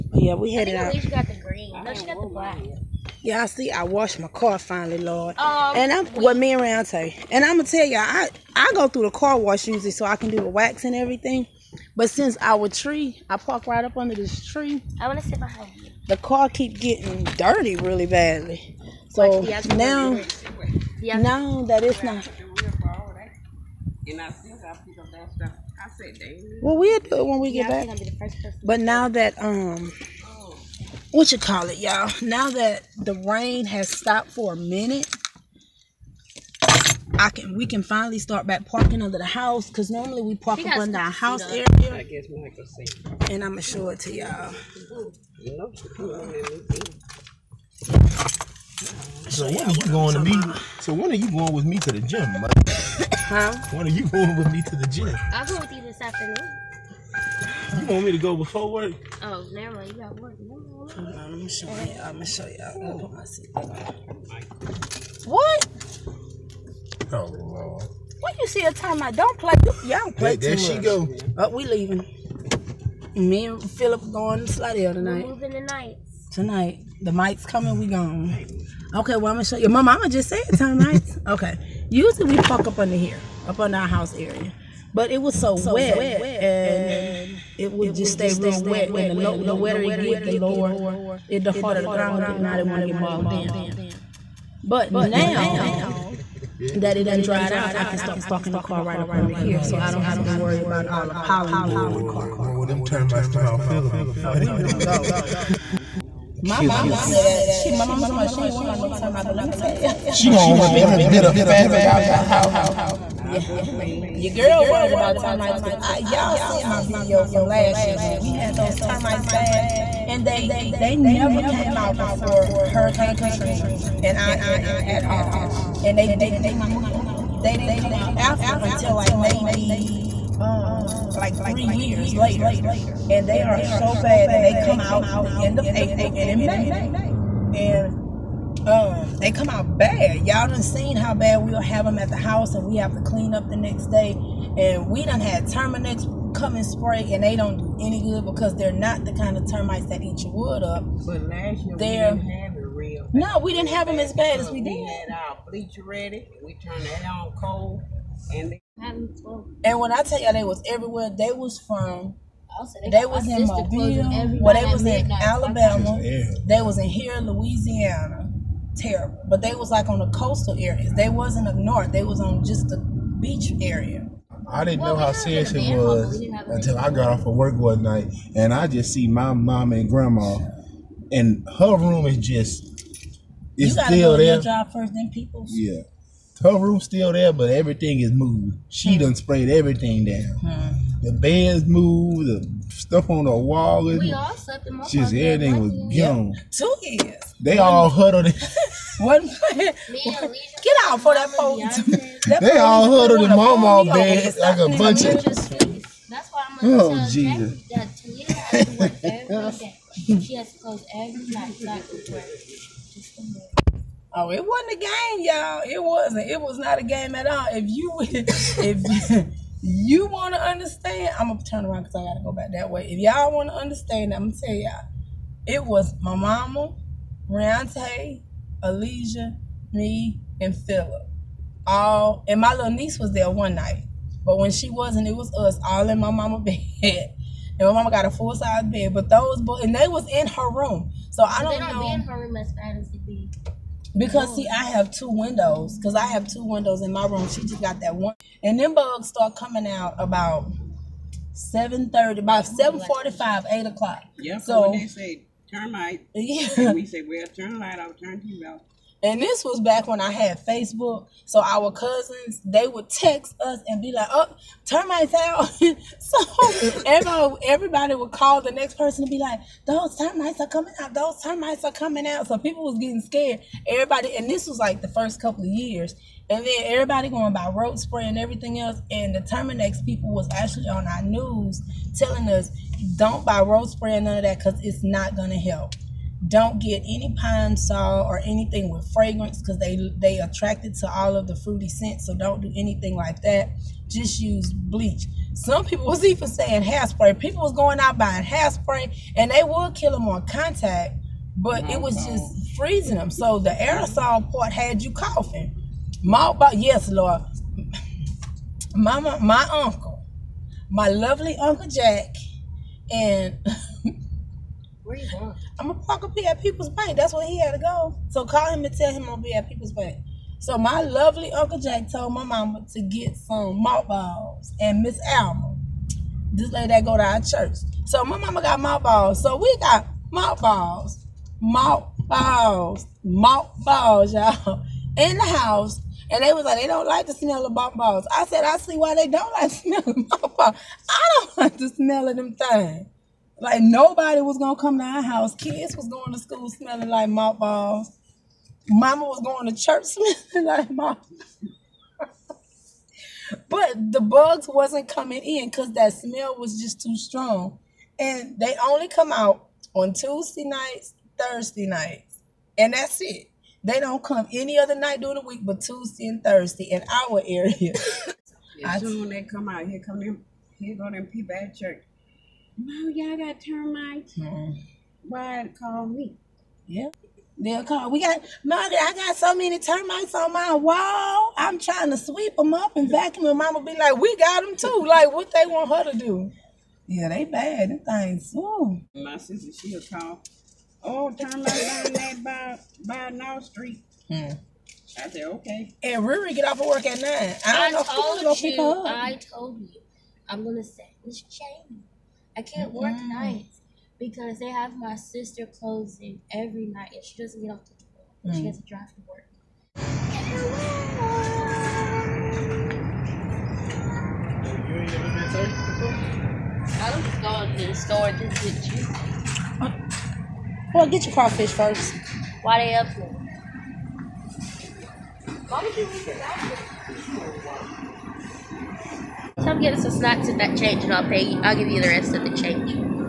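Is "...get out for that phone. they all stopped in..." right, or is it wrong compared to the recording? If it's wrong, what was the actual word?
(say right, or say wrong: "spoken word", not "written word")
wrong: "huddled", not "stopped".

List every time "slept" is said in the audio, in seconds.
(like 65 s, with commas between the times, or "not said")
194 s.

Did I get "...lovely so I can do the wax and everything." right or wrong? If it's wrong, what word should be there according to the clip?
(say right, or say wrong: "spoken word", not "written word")
wrong: "usually", not "lovely".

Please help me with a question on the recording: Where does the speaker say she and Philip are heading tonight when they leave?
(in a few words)
Slidell.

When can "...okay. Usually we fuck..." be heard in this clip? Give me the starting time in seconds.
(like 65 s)
81 s.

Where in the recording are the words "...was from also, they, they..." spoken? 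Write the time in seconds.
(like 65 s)
161 s.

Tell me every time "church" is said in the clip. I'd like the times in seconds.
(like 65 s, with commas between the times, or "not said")
327 s, 349 s, 371 s.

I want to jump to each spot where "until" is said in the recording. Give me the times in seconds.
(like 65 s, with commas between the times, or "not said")
128 s, 176 s.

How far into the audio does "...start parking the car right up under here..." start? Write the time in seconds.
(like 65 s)
97 s.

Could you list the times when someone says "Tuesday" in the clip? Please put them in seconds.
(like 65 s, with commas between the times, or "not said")
359 s, 365 s.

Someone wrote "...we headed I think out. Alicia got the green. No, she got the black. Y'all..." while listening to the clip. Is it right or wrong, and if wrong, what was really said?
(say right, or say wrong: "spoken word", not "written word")
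right.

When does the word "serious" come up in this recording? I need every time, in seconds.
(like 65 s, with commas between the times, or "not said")
175 s.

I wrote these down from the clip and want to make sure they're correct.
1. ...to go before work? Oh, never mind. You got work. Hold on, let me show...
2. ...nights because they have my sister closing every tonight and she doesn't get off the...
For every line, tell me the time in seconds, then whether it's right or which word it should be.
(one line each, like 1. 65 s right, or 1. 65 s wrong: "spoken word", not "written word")
1. 58 s right
2. 403 s wrong: "night", not "tonight".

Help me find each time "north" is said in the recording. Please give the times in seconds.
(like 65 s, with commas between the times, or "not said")
171 s, 393 s.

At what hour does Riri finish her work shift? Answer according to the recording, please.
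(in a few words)
9.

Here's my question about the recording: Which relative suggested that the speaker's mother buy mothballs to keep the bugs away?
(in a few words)
Uncle Jake.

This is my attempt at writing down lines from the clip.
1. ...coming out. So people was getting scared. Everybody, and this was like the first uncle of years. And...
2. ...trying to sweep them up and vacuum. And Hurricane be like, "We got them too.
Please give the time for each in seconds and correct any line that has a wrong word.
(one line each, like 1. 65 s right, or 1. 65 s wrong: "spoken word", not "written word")
1. 271 s wrong: "couple", not "uncle"
2. 381 s wrong: "Mama", not "Hurricane".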